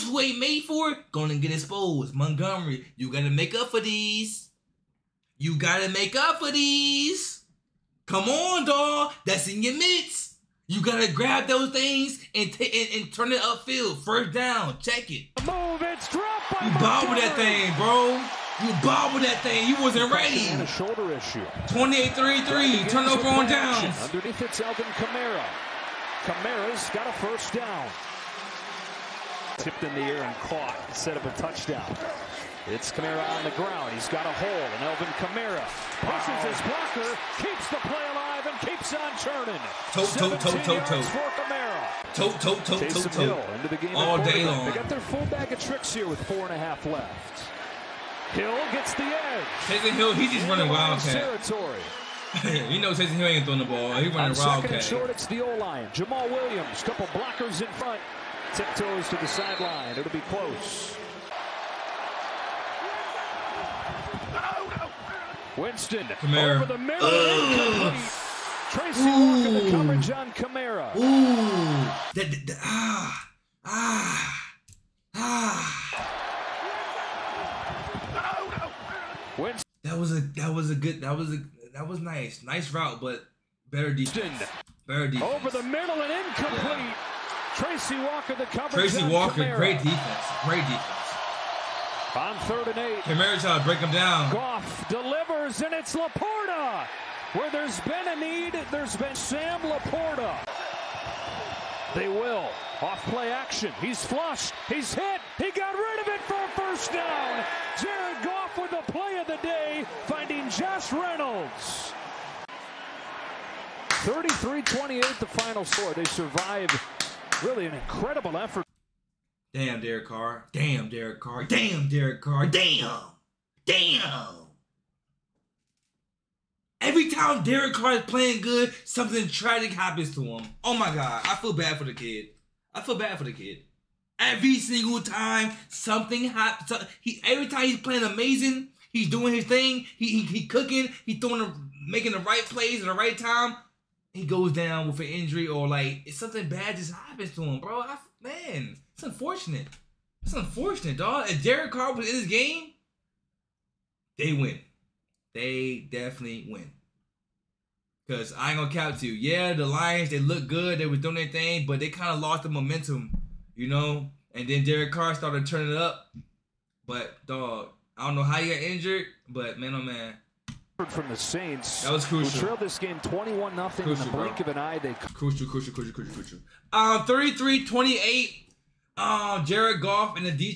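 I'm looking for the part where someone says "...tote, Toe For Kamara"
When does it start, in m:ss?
0:40.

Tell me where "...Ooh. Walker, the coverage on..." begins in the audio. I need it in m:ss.
1:09.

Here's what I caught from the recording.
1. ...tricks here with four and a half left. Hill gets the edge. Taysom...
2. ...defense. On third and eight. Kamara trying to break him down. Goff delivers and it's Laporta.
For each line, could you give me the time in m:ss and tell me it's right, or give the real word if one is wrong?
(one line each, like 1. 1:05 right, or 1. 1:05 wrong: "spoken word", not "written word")
1. 0:45 right
2. 1:30 right.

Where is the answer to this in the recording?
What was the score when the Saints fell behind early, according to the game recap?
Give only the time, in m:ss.
2:53.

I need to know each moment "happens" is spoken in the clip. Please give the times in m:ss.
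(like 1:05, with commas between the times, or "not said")
2:09, 2:16, 2:26.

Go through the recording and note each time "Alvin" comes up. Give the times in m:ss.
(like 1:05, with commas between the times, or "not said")
0:24, 0:34.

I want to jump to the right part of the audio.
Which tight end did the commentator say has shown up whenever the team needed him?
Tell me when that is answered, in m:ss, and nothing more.
1:39.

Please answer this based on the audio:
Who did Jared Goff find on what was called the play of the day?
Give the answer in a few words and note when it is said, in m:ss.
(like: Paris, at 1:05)
Josh Reynolds, at 1:50.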